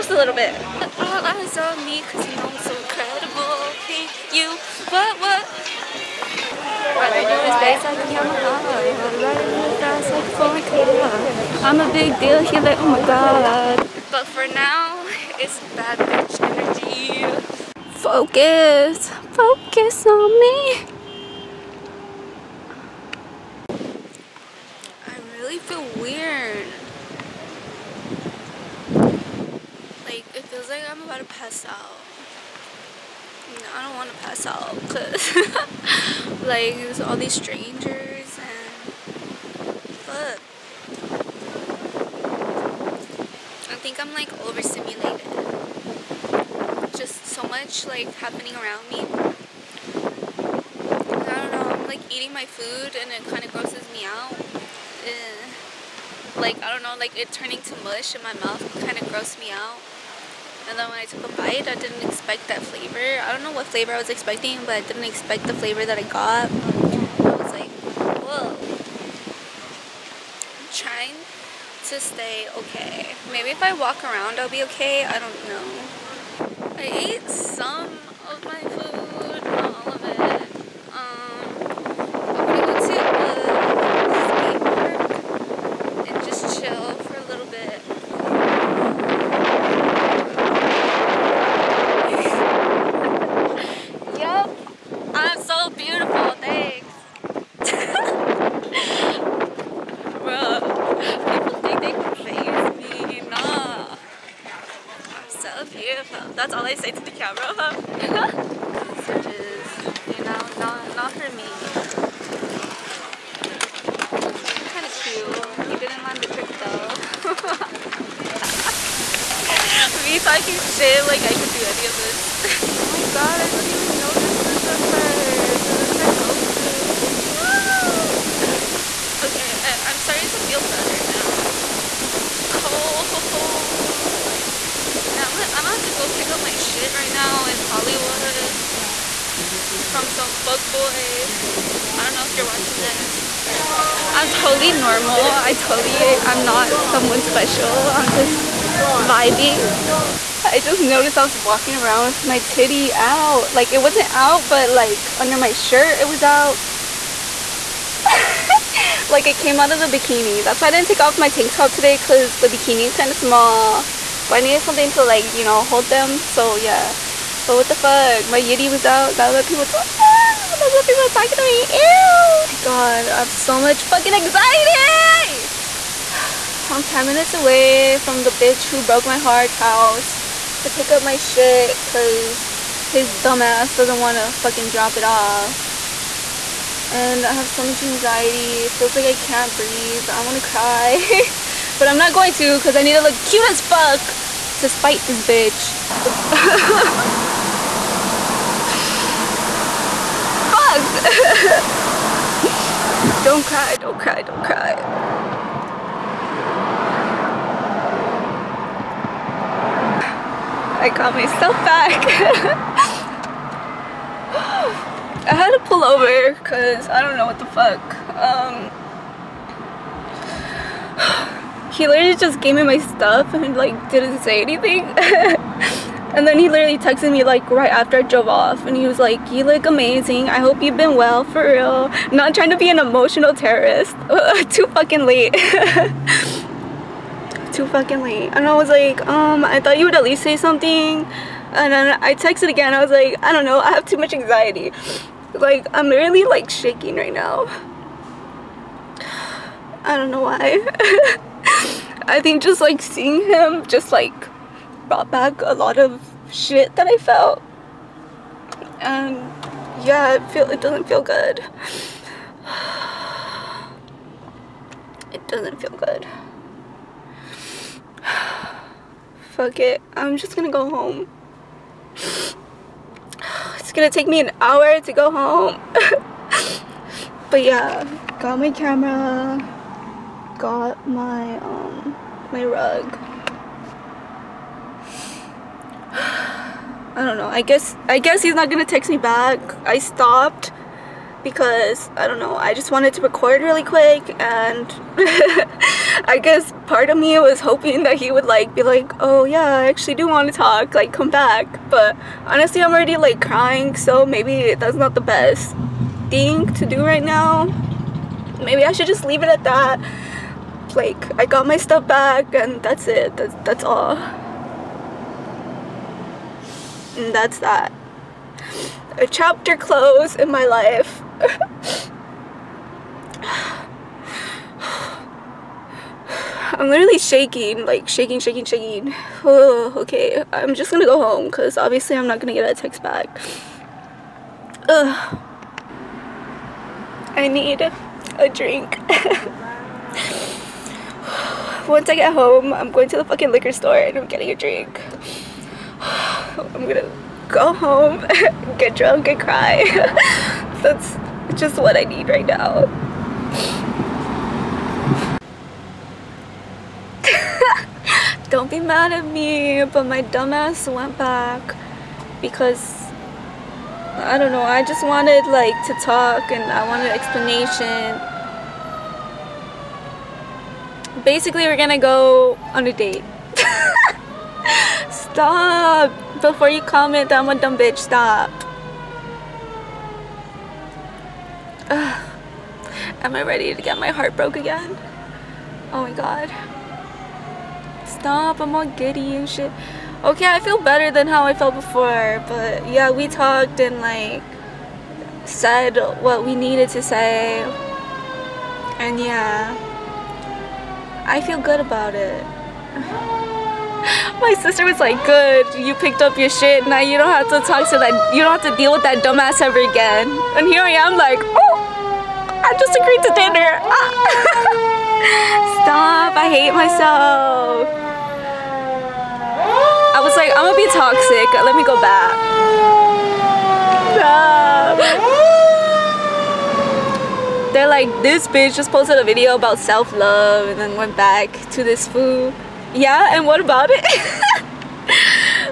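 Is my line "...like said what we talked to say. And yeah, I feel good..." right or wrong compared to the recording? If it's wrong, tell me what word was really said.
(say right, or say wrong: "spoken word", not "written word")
wrong: "needed", not "talked".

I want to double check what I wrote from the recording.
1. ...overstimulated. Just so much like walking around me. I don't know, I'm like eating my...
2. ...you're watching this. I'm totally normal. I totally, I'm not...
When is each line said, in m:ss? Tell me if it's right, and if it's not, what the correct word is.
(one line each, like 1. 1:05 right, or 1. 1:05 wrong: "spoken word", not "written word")
1. 0:44 wrong: "happening", not "walking"
2. 2:22 right.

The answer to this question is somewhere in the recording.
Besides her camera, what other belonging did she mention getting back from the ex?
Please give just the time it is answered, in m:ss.
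4:42.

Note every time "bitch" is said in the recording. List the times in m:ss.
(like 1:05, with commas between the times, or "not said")
0:15, 2:58, 3:15, 6:17, 7:08.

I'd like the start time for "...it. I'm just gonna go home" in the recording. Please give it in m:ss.
4:29.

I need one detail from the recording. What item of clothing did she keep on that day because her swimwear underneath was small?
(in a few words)
tank top.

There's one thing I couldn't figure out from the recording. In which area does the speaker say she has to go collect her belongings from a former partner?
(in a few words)
Hollywood.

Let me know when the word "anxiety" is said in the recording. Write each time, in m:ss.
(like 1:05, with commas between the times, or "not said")
2:54, 3:07, 4:04.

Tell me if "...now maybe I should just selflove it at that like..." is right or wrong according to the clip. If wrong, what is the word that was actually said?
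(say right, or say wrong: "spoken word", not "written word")
wrong: "leave", not "selflove".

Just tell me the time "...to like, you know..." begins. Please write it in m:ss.
2:44.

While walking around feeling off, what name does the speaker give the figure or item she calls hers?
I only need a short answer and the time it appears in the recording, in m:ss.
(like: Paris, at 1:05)
my Goku, at 2:05.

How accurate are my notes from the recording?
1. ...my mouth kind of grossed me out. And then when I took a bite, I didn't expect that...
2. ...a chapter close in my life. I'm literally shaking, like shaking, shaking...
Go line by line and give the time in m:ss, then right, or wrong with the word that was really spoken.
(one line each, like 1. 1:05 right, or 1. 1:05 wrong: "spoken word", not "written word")
1. 0:58 right
2. 5:18 right.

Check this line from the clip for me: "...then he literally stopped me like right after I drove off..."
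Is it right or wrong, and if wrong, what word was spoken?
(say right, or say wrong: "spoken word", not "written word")
wrong: "texted", not "stopped".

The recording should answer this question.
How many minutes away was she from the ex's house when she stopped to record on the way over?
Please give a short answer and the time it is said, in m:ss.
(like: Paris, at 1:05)
10, at 2:56.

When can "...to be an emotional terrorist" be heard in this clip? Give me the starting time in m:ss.
3:52.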